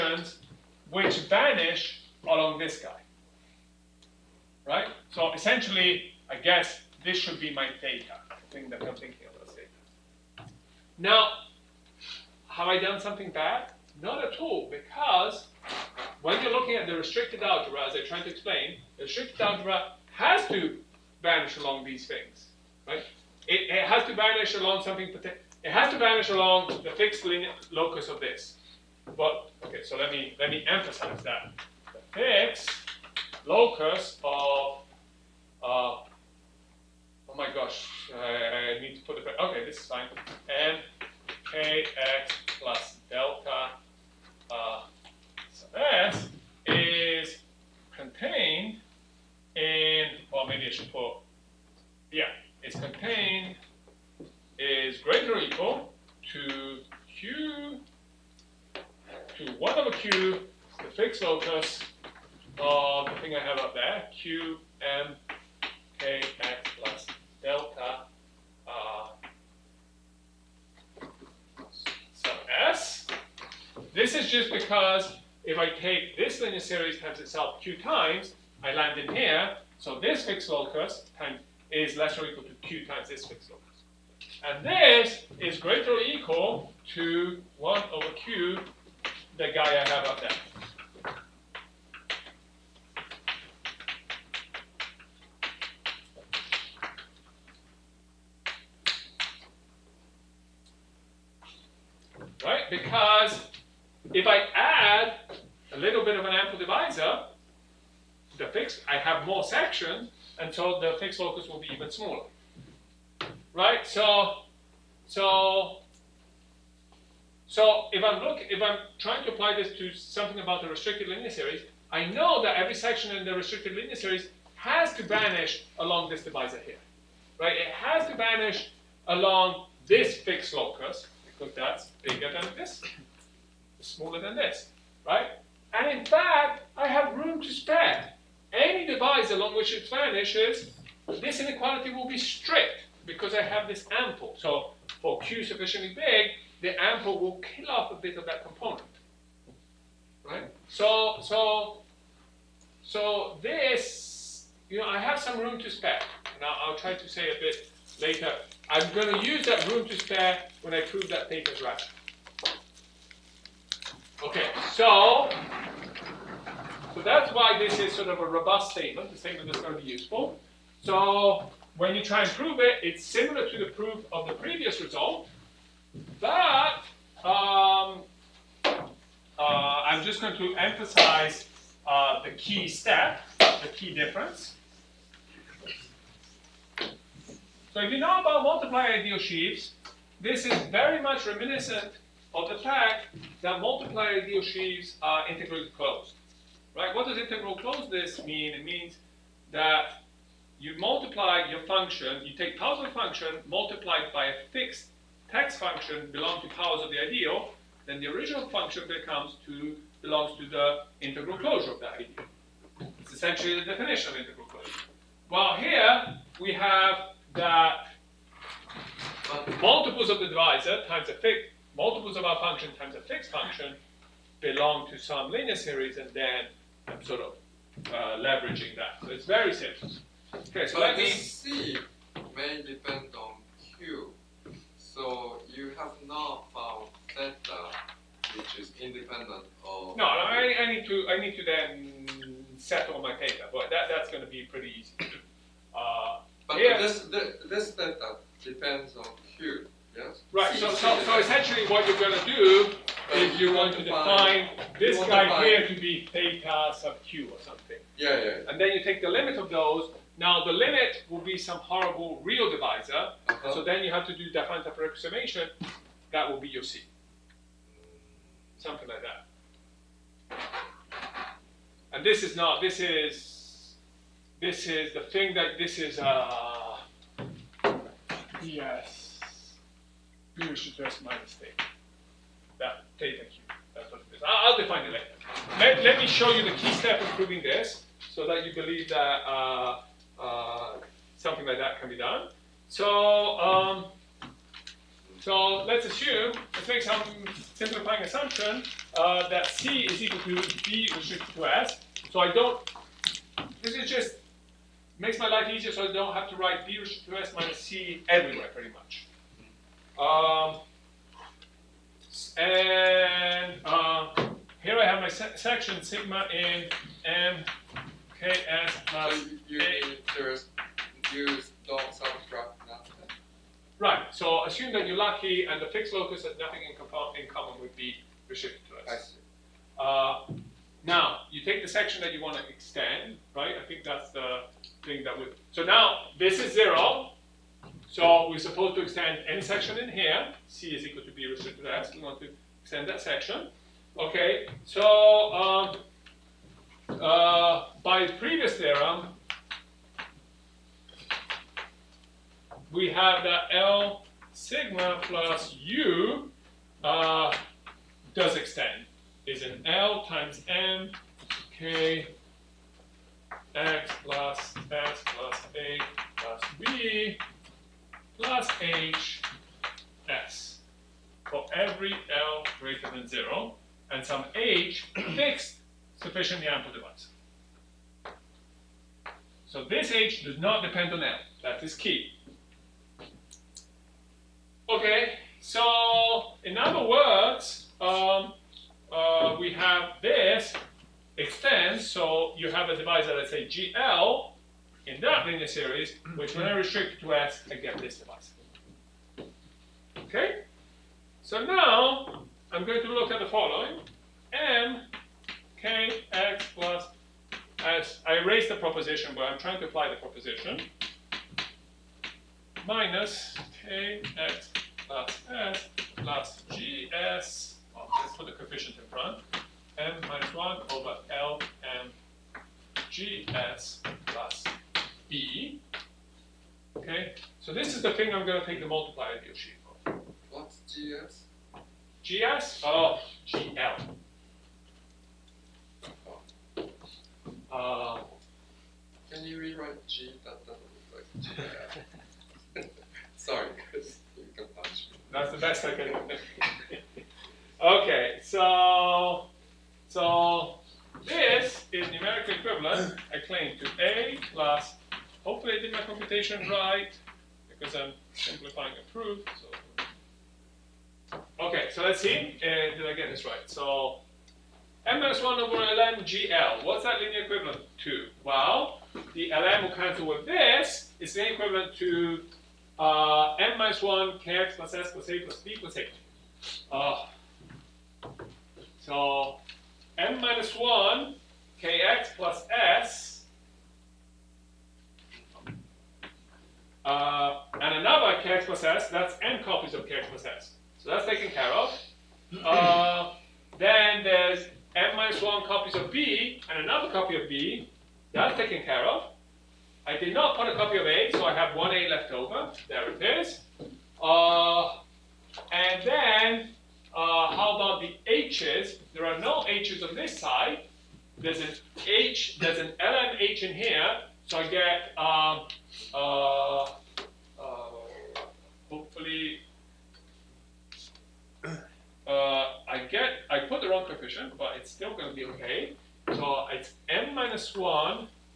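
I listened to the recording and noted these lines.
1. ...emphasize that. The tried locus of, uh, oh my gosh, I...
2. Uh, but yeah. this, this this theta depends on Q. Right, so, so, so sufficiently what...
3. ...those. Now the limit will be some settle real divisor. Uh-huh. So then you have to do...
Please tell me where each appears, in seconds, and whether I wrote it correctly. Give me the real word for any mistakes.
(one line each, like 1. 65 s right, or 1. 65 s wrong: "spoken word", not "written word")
1. 30 s wrong: "fixed", not "tried"
2. 245 s wrong: "essentially", not "sufficiently"
3. 259 s wrong: "horrible", not "settle".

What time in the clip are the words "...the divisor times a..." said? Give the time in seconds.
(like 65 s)
220 s.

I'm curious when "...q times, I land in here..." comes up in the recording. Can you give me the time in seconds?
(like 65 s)
77 s.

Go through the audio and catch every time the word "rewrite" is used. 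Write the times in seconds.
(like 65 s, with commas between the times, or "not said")
439 s.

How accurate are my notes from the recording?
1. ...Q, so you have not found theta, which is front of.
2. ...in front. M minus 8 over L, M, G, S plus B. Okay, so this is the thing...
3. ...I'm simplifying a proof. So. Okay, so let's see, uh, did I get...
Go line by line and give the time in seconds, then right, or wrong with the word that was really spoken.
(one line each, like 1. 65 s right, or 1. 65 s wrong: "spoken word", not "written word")
1. 233 s wrong: "independent", not "front"
2. 418 s wrong: "1", not "8"
3. 457 s right.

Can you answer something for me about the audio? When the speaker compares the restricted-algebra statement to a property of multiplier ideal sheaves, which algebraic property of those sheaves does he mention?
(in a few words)
integrally closed.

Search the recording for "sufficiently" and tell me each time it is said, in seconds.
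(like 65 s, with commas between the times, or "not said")
145 s, 376 s.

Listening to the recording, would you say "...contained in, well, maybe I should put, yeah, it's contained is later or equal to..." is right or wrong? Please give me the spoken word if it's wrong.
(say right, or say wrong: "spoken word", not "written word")
wrong: "greater", not "later".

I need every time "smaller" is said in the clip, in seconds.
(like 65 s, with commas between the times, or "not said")
111 s, 133 s.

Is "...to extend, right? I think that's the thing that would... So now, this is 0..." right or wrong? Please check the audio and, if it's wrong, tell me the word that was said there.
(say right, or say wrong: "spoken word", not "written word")
right.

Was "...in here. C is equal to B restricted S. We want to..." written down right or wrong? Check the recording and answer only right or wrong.
right.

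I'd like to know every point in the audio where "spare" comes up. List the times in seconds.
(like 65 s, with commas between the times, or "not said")
137 s, 155 s, 159 s.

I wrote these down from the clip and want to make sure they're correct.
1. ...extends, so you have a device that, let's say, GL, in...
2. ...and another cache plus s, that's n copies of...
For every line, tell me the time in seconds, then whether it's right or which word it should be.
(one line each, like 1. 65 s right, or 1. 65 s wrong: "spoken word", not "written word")
1. 391 s right
2. 487 s right.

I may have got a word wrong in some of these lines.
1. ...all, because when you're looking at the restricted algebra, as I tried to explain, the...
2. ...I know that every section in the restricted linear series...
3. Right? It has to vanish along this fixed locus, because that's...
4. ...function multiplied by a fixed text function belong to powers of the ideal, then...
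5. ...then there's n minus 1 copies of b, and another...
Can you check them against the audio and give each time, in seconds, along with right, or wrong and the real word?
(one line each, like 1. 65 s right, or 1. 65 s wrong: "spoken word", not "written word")
1. 14 s right
2. 121 s right
3. 127 s right
4. 202 s right
5. 493 s right.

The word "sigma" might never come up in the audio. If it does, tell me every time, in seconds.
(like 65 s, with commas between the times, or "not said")
315 s, 354 s.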